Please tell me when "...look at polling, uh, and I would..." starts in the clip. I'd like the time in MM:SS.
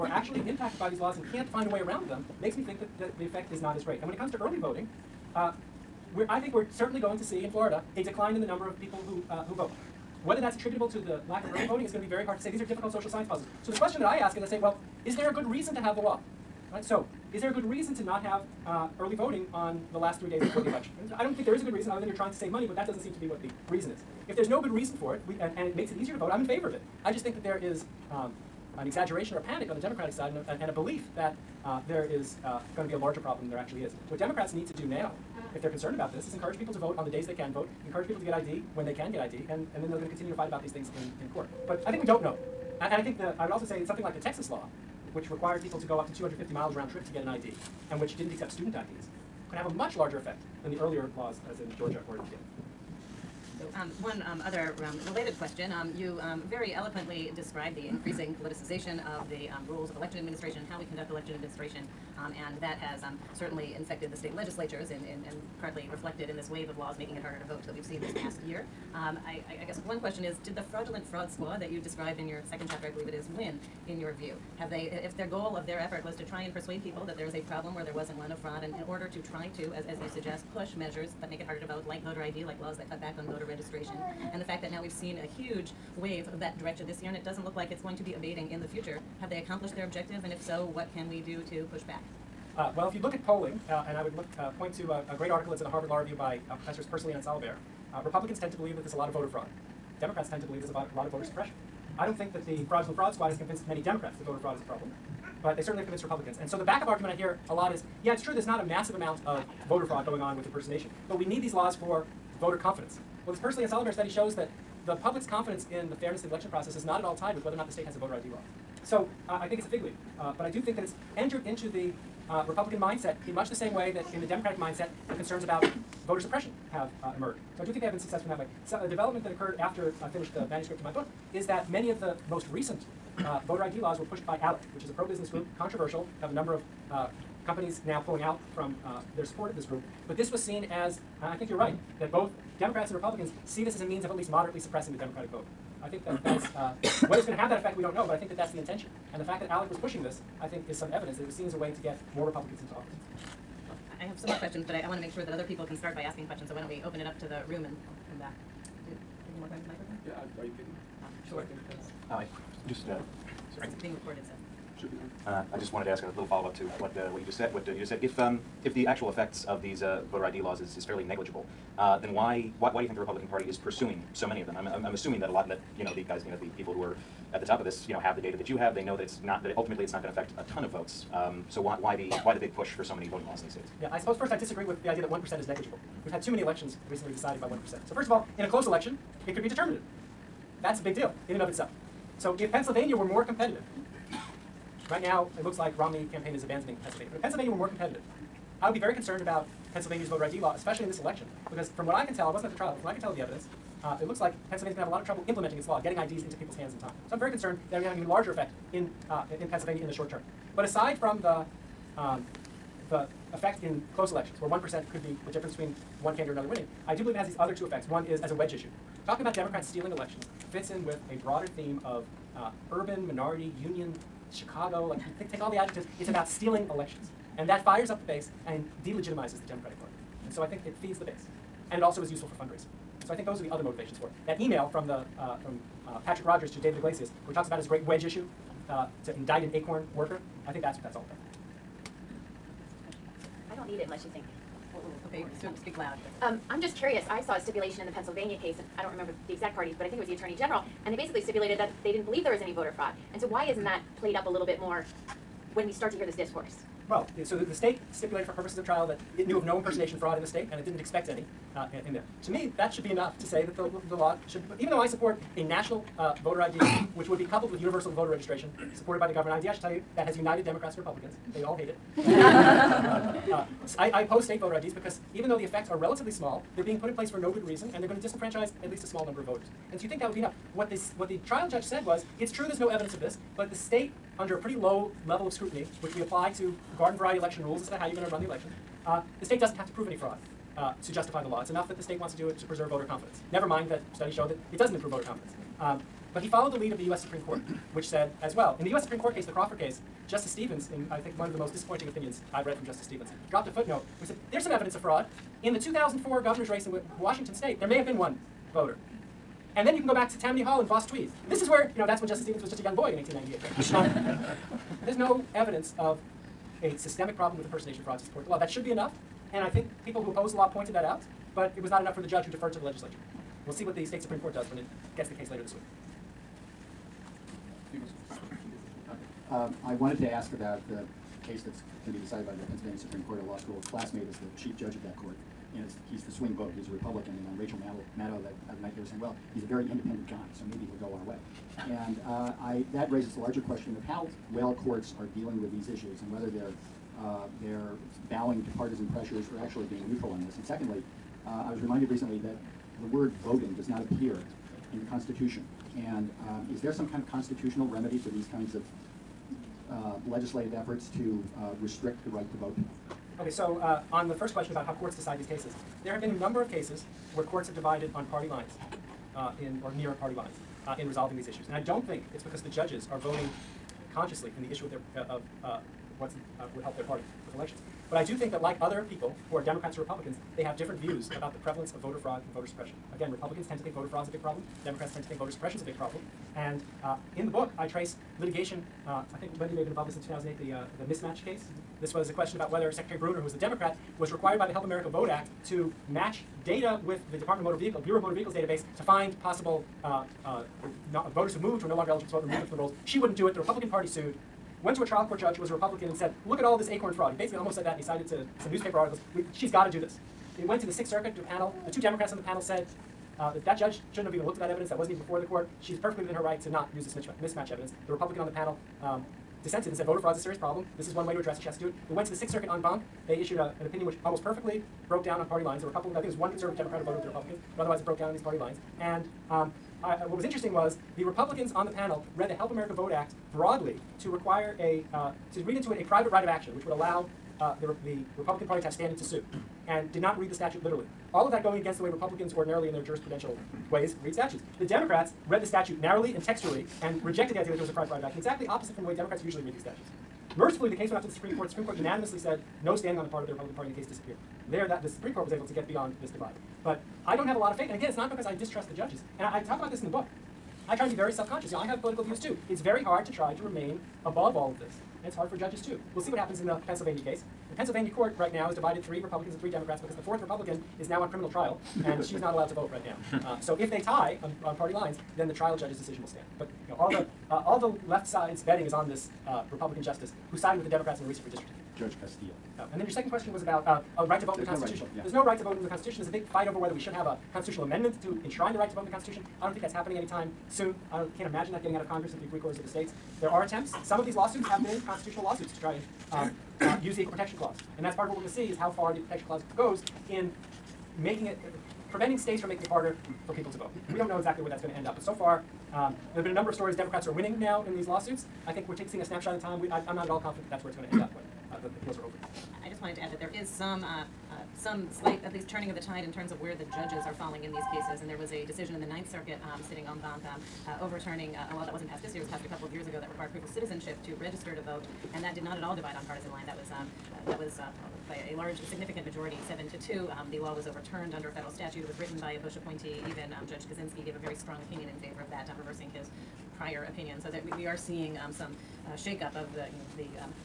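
01:33.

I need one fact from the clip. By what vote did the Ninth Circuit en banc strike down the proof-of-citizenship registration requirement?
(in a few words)
7 to 2.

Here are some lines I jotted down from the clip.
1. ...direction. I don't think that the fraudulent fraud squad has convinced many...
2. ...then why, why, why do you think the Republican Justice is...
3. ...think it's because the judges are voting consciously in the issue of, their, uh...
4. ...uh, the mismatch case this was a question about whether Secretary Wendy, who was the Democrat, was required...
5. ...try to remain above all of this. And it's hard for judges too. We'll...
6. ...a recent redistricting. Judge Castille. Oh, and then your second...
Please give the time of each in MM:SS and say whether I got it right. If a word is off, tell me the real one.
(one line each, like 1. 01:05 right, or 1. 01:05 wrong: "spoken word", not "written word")
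1. 01:41 wrong: "suppression", not "direction"
2. 02:51 wrong: "Party", not "Justice"
3. 06:11 right
4. 06:30 wrong: "Brunner", not "Wendy"
5. 07:43 right
6. 08:01 right.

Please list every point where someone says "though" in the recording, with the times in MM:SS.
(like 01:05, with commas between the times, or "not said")
04:24, 04:35.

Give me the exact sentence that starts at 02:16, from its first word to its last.
have a number of uh, companies now pulling out from uh, their support of this group.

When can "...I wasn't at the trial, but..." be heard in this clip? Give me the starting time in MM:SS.
03:22.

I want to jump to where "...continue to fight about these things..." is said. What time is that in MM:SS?
00:40.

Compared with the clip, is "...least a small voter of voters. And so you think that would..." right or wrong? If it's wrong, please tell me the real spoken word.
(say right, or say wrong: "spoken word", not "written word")
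wrong: "number", not "voter".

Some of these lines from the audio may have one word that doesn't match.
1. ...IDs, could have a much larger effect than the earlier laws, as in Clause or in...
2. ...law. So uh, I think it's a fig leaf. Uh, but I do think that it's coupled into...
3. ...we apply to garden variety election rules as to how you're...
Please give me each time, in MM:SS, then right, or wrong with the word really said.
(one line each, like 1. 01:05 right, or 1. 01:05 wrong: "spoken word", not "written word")
1. 00:48 wrong: "Georgia", not "Clause"
2. 01:58 wrong: "entered", not "coupled"
3. 04:45 right.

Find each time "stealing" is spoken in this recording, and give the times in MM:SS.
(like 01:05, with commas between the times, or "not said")
03:39, 03:46.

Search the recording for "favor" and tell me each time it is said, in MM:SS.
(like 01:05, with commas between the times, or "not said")
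00:26, 08:54.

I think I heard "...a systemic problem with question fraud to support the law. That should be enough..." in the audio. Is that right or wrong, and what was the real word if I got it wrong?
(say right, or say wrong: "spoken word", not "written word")
wrong: "impersonation", not "question".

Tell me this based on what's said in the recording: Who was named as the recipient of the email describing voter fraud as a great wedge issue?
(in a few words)
David Iglesias.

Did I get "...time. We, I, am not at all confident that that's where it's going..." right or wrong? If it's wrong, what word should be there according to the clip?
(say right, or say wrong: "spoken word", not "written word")
right.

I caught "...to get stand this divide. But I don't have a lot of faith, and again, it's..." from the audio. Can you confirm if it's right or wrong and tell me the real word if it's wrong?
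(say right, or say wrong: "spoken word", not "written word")
wrong: "beyond", not "stand".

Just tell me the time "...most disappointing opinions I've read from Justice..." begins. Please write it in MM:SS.
05:01.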